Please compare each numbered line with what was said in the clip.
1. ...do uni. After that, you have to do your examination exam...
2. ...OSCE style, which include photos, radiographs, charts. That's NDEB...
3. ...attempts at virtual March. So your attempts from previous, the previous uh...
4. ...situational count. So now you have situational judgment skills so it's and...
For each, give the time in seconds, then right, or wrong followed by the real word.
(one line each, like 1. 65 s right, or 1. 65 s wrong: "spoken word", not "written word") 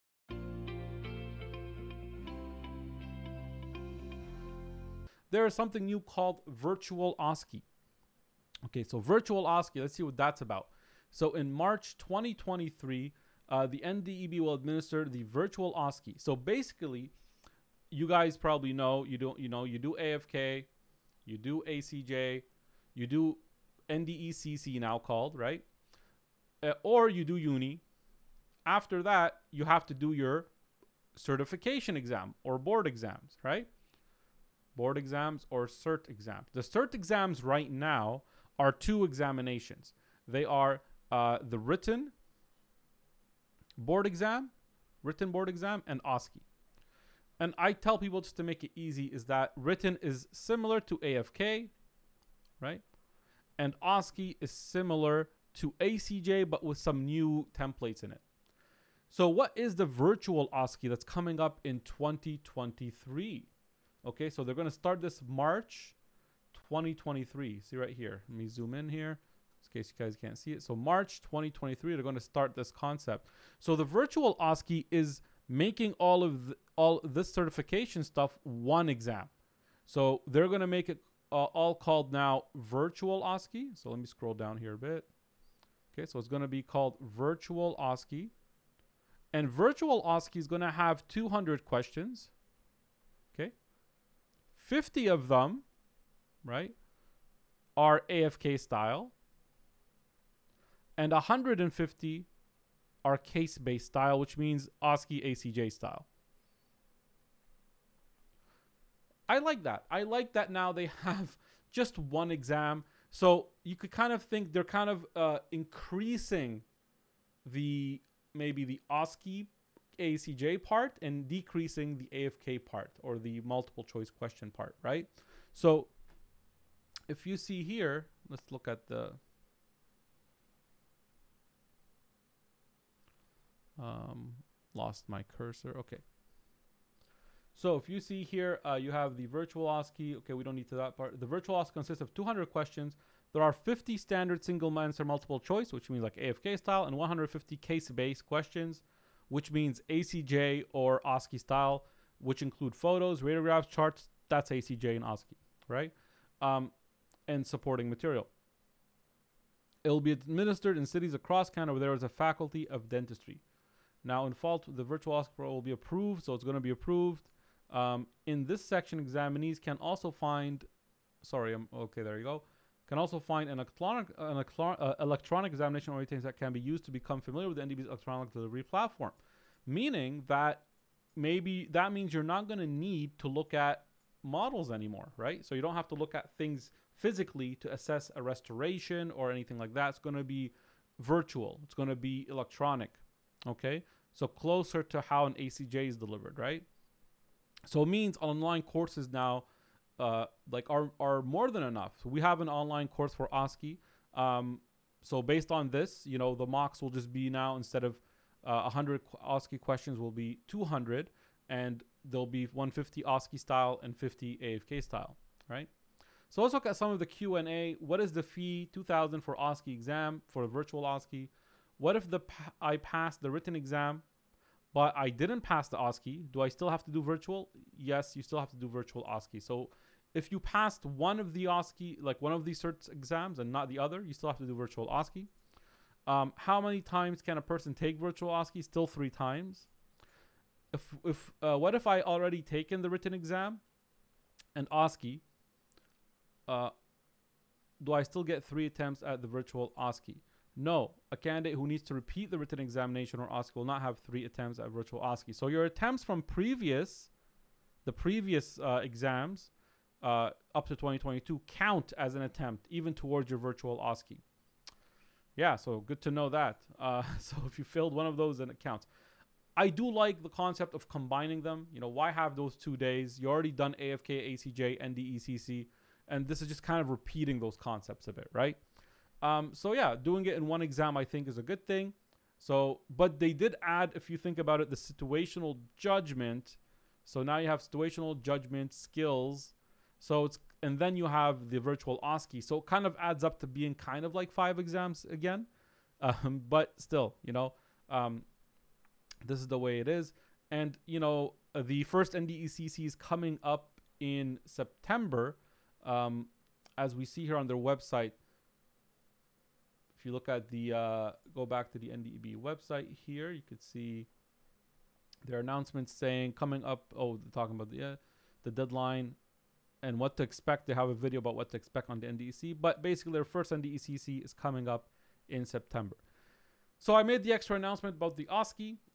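1. 27 s wrong: "certification", not "examination"
2. 151 s wrong: "ACJ", not "NDEB"
3. 254 s wrong: "OSCE", not "March"
4. 284 s wrong: "judgment", not "count".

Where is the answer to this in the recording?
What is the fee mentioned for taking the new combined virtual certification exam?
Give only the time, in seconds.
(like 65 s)
218 s.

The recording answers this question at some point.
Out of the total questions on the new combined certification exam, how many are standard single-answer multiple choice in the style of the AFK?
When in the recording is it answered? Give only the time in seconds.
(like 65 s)
94 s.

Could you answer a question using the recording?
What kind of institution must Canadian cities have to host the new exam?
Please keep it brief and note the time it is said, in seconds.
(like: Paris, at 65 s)
a faculty of dentistry, at 162 s.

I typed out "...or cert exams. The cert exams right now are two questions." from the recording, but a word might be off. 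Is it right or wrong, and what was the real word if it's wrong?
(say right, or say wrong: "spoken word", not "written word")
wrong: "examinations", not "questions".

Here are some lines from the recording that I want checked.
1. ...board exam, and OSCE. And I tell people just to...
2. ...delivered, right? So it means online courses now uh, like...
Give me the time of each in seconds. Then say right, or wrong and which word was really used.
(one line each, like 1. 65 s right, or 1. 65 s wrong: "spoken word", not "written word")
1. 45 s right
2. 195 s right.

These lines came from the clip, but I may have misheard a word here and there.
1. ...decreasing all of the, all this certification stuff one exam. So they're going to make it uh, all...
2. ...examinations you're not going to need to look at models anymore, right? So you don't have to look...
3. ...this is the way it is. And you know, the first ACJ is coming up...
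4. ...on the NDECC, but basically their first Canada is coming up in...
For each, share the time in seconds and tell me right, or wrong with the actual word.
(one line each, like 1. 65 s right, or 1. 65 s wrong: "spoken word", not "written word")
1. 75 s wrong: "making", not "decreasing"
2. 181 s wrong: "means", not "examinations"
3. 299 s wrong: "NDECC", not "ACJ"
4. 321 s wrong: "NDECC", not "Canada".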